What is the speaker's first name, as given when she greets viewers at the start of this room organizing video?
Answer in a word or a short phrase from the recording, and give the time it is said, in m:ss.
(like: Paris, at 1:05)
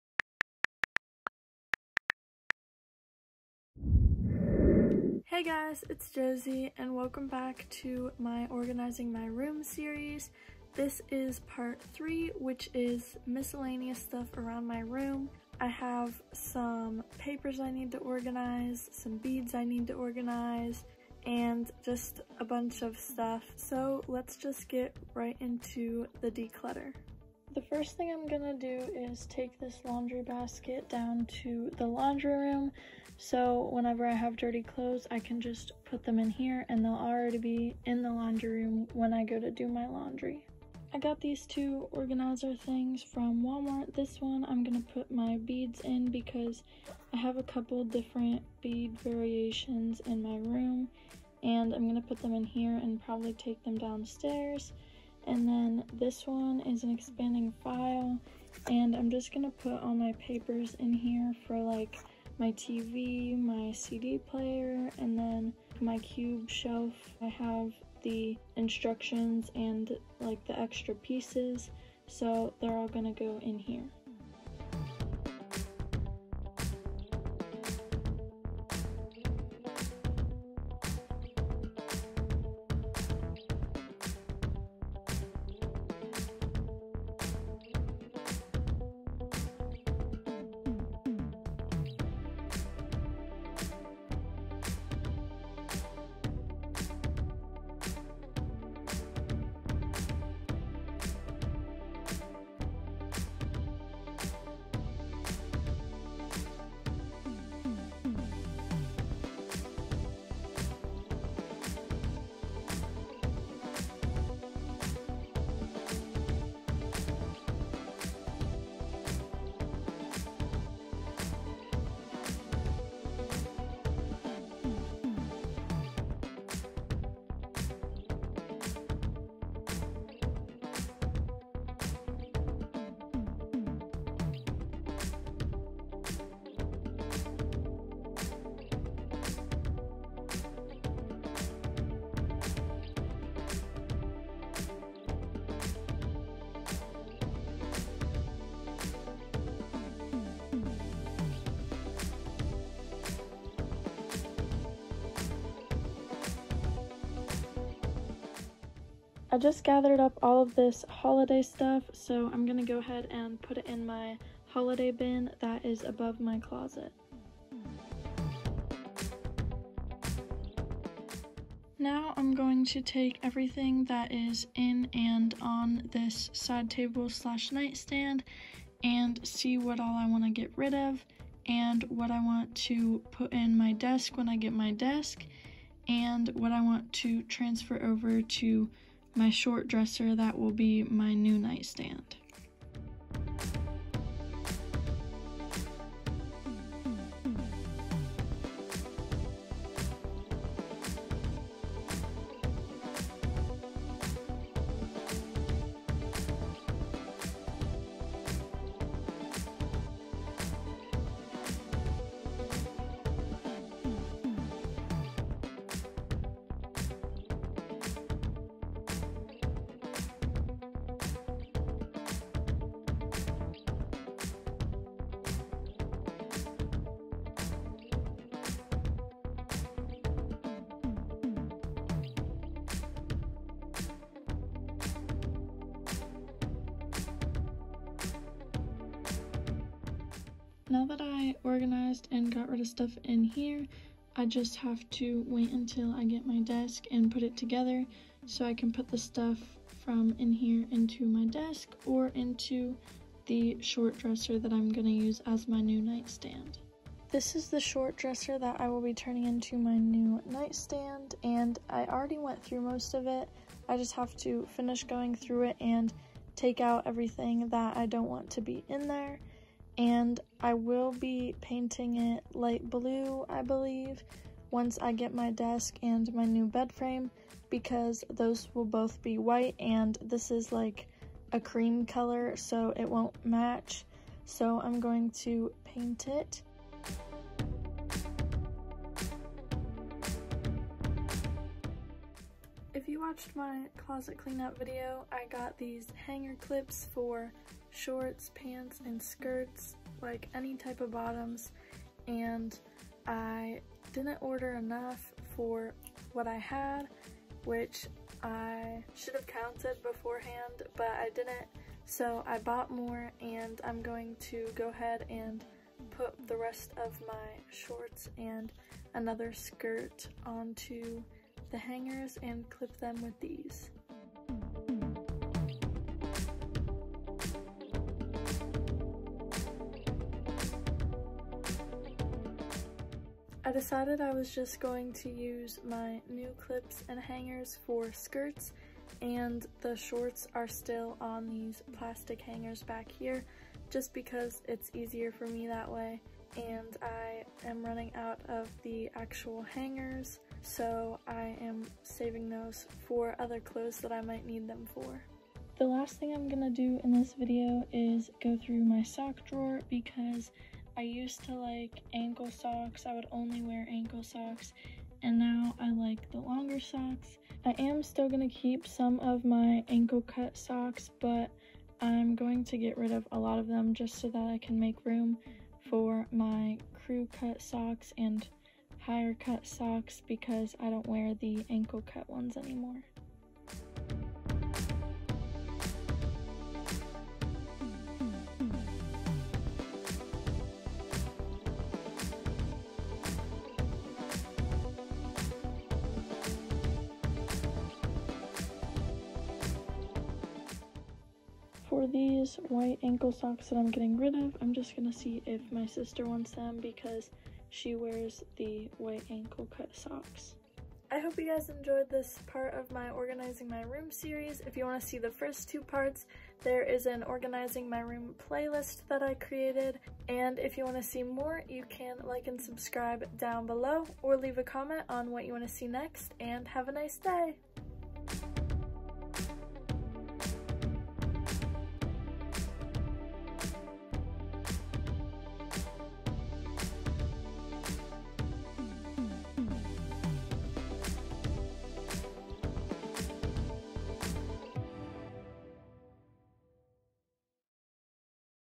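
Josie, at 0:06.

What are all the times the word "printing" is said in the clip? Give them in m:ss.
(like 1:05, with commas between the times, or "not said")
not said.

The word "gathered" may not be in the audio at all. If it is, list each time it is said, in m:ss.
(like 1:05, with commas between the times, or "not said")
2:39.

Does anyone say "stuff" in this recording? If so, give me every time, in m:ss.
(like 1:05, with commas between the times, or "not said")
0:13, 0:22, 2:41, 4:02, 4:08.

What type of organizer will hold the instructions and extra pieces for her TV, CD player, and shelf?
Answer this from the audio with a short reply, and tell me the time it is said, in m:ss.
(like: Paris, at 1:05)
expanding file, at 0:56.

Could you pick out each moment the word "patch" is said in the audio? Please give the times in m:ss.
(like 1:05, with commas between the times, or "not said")
not said.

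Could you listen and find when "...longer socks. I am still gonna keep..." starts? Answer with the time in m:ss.
6:06.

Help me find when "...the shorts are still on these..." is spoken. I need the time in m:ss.
5:39.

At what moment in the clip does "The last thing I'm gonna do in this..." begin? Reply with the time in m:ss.
5:55.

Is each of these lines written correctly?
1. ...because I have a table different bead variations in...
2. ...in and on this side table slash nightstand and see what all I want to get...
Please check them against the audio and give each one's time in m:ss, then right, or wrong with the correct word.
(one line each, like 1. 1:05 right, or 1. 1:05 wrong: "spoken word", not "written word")
1. 0:46 wrong: "couple", not "table"
2. 2:54 right.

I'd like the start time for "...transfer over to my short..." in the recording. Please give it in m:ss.
3:07.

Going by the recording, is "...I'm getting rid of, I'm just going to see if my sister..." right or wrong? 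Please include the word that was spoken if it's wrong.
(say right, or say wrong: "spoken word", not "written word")
right.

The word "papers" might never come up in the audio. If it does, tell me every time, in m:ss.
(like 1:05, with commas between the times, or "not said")
0:17, 1:00.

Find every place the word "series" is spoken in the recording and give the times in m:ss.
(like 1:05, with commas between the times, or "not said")
0:09, 6:53.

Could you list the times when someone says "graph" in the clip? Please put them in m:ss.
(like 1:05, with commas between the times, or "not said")
not said.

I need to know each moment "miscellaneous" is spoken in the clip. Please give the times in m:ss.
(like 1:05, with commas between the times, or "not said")
0:13.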